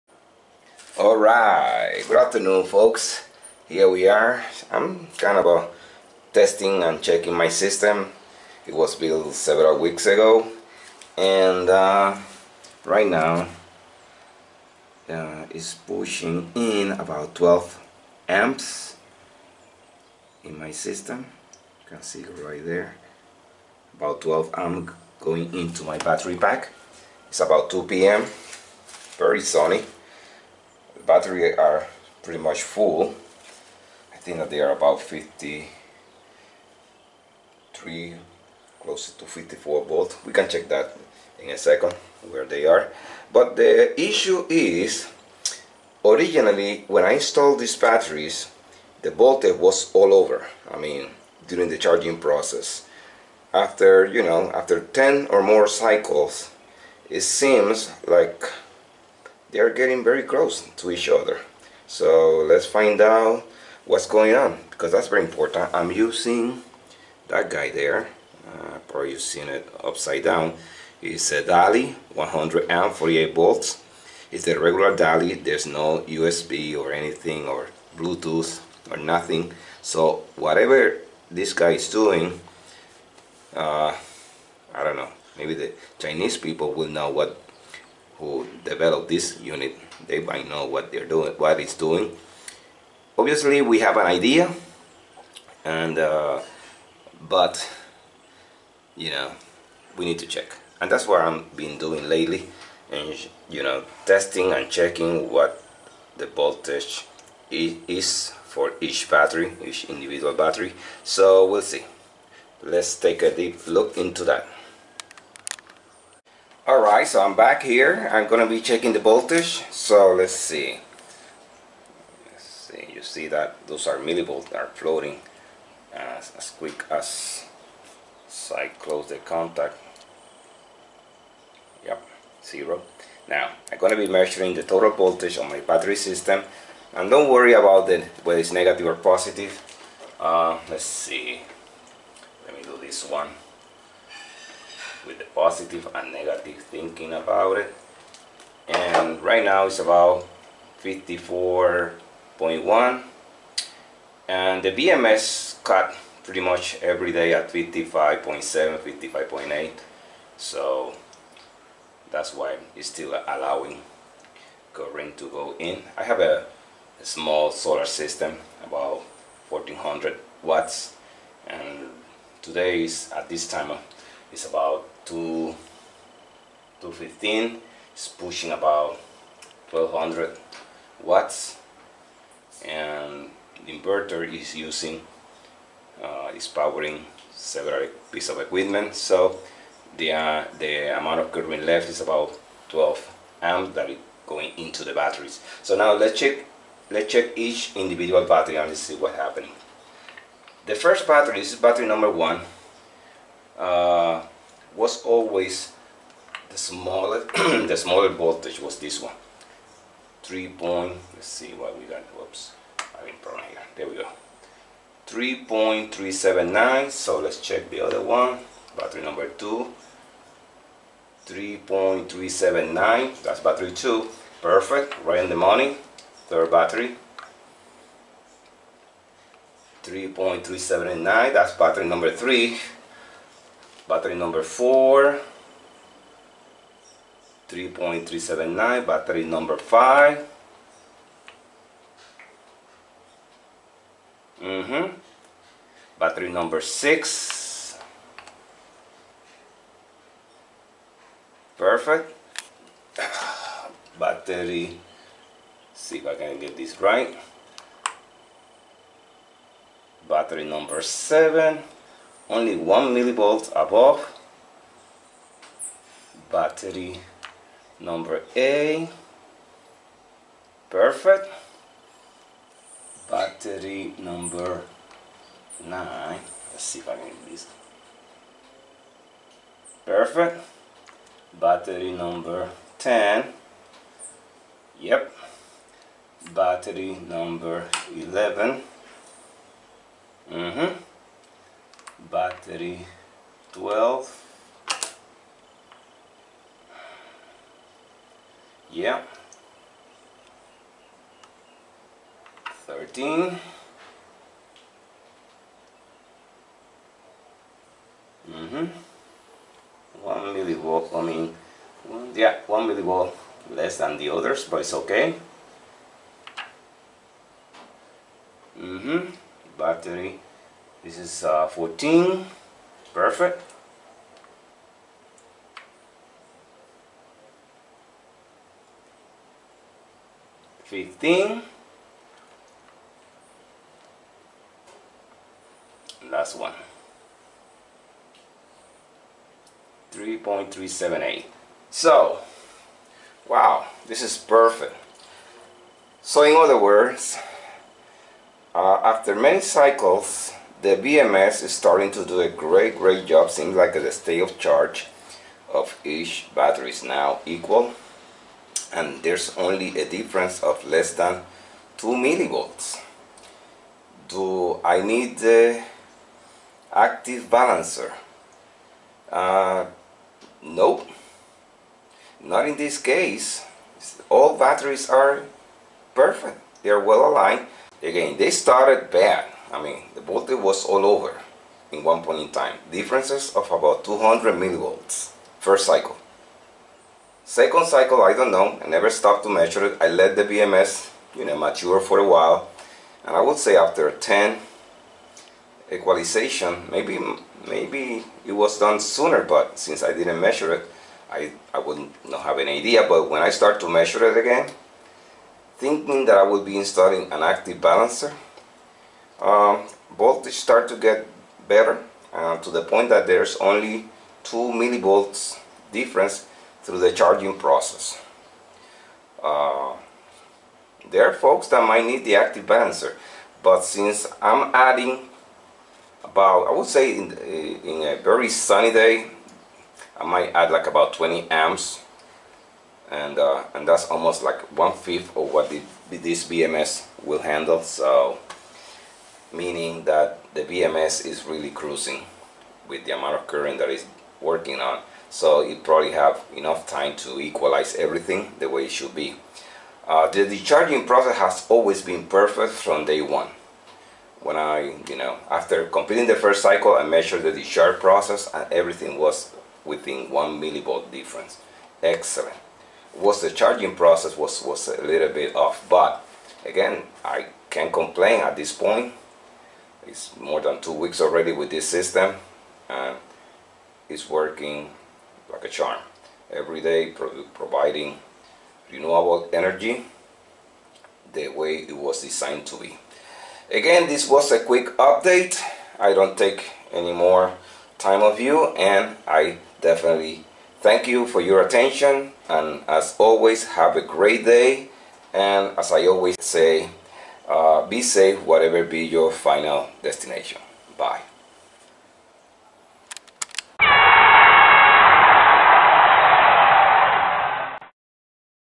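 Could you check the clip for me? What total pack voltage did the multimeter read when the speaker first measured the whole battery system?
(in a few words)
54.1.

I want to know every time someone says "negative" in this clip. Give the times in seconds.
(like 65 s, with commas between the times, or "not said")
138 s, 146 s.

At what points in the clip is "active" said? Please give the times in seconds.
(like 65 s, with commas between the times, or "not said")
366 s, 407 s, 422 s.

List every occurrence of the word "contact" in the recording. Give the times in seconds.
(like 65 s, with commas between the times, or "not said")
129 s.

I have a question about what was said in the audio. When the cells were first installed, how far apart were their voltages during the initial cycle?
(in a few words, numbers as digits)
about 200 millivolts.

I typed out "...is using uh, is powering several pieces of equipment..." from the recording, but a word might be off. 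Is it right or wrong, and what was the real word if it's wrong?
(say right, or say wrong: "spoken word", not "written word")
right.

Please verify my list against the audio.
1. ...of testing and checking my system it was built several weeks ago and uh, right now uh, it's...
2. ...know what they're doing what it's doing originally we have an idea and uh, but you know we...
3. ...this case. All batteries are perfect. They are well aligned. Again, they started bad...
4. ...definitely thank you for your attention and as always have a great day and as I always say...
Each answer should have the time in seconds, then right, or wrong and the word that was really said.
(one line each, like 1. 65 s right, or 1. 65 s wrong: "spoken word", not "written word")
1. 5 s right
2. 90 s wrong: "obviously", not "originally"
3. 372 s right
4. 489 s right.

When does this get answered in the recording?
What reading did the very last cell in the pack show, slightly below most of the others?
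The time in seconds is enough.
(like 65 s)
339 s.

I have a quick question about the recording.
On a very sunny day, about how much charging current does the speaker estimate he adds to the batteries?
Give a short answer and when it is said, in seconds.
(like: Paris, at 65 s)
20 amps, at 430 s.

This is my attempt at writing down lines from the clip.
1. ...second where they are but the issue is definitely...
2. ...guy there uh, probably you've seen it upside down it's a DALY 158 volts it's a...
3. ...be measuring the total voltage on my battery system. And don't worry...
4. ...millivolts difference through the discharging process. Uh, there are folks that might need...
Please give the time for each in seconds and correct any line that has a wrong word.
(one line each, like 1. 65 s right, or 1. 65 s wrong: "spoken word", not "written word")
1. 41 s wrong: "originally", not "definitely"
2. 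67 s wrong: "148", not "158"
3. 134 s right
4. 414 s wrong: "charging", not "discharging".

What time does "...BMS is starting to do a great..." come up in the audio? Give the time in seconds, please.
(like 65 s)
350 s.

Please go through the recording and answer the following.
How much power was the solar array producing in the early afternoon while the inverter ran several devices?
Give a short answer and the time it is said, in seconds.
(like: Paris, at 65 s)
1200 watts, at 179 s.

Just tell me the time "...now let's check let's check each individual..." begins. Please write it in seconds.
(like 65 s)
195 s.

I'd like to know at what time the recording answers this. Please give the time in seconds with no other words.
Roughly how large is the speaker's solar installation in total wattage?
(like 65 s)
169 s.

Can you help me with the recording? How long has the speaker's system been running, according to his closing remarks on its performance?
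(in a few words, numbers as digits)
more than two weeks.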